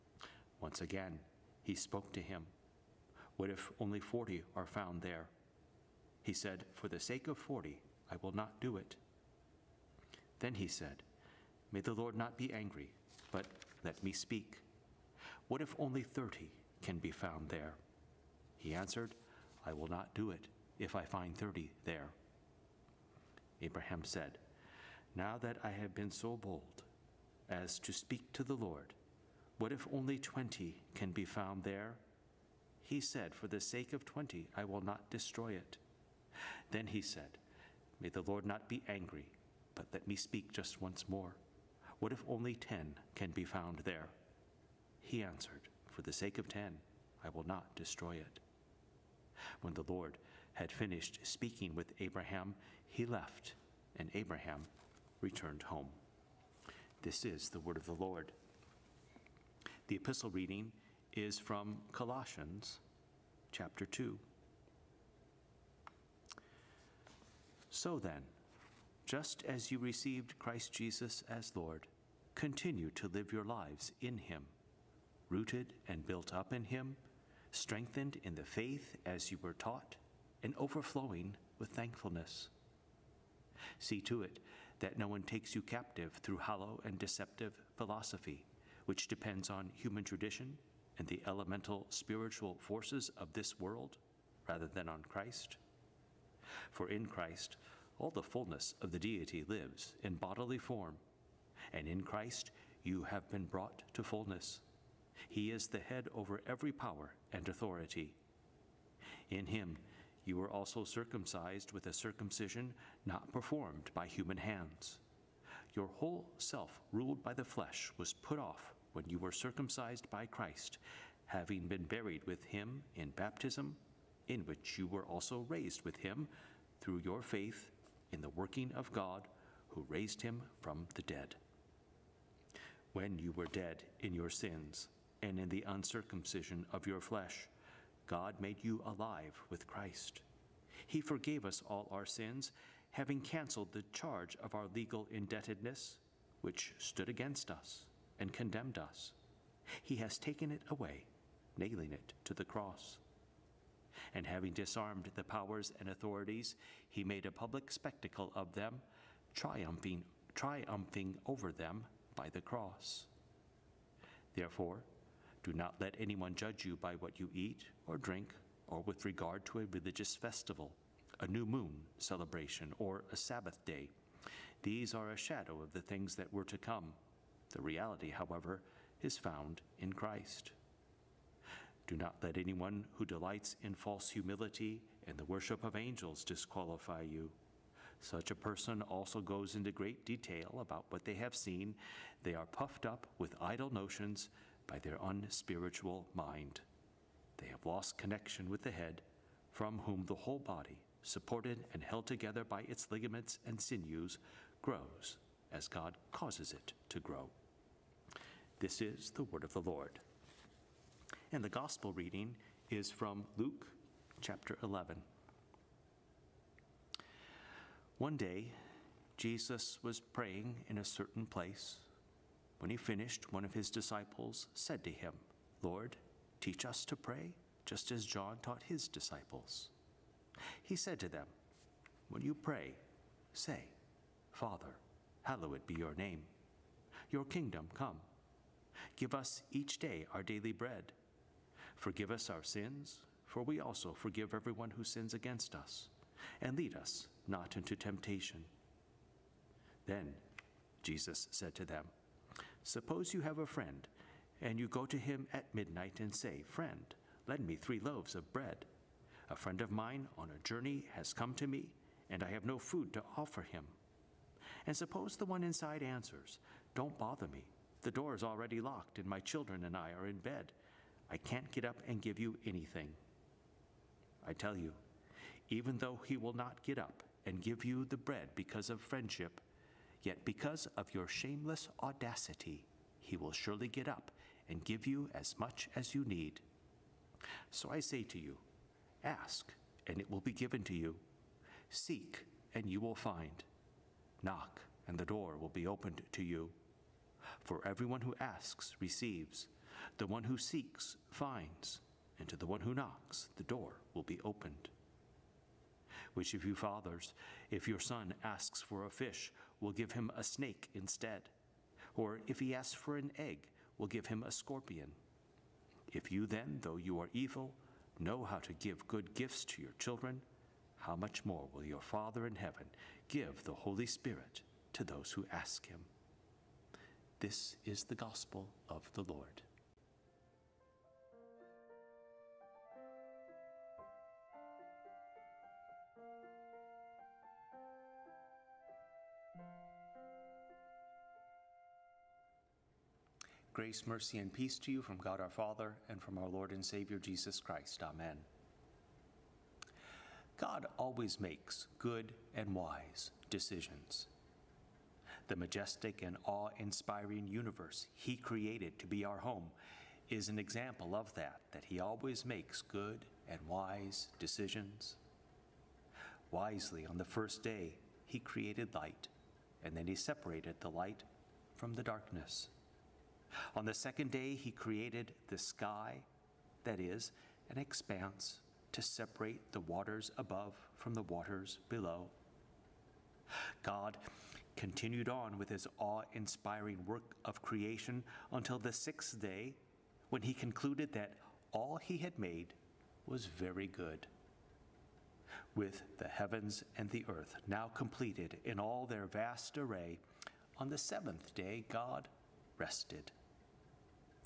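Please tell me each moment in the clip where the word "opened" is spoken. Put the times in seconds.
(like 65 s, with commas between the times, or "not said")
295 s, 304 s.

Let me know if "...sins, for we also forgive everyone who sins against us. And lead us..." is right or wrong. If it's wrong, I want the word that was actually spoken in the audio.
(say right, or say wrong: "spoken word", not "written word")
right.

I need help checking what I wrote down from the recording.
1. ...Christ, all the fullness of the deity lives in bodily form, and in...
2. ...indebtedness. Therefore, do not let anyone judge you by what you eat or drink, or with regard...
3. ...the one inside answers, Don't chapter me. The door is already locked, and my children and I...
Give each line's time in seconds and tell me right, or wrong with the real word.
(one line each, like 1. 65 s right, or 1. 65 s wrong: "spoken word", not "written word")
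1. 97 s right
2. 162 s wrong: "cross", not "indebtedness"
3. 265 s wrong: "bother", not "chapter".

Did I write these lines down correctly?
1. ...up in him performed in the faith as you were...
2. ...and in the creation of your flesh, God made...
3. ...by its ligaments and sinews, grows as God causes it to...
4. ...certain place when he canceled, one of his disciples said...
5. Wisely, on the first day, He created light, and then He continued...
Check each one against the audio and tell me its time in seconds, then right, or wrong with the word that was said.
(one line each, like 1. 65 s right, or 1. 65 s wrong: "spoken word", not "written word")
1. 76 s wrong: "strengthened", not "performed"
2. 135 s wrong: "uncircumcision", not "creation"
3. 202 s right
4. 220 s wrong: "finished", not "canceled"
5. 366 s wrong: "separated", not "continued".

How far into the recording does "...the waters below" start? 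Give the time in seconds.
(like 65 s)
380 s.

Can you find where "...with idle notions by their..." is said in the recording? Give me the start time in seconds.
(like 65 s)
193 s.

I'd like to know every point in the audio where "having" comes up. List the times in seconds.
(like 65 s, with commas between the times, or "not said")
121 s, 142 s, 154 s.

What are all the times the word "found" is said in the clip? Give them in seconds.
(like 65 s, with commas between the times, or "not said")
4 s, 17 s, 31 s, 43 s, 179 s.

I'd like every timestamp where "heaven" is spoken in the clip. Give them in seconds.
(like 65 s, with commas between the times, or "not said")
322 s, 396 s.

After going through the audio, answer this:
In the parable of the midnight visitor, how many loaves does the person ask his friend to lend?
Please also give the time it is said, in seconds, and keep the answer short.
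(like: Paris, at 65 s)
3, at 257 s.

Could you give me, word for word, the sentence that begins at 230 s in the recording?
He said to them, When you pray, say, Father, hallowed be your name.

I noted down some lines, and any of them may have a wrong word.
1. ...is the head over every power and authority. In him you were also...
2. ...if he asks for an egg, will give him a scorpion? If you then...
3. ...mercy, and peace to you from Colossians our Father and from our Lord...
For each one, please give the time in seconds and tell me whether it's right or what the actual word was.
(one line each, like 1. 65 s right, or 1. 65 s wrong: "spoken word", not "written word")
1. 105 s right
2. 312 s right
3. 343 s wrong: "God", not "Colossians".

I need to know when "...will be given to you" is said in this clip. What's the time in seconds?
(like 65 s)
290 s.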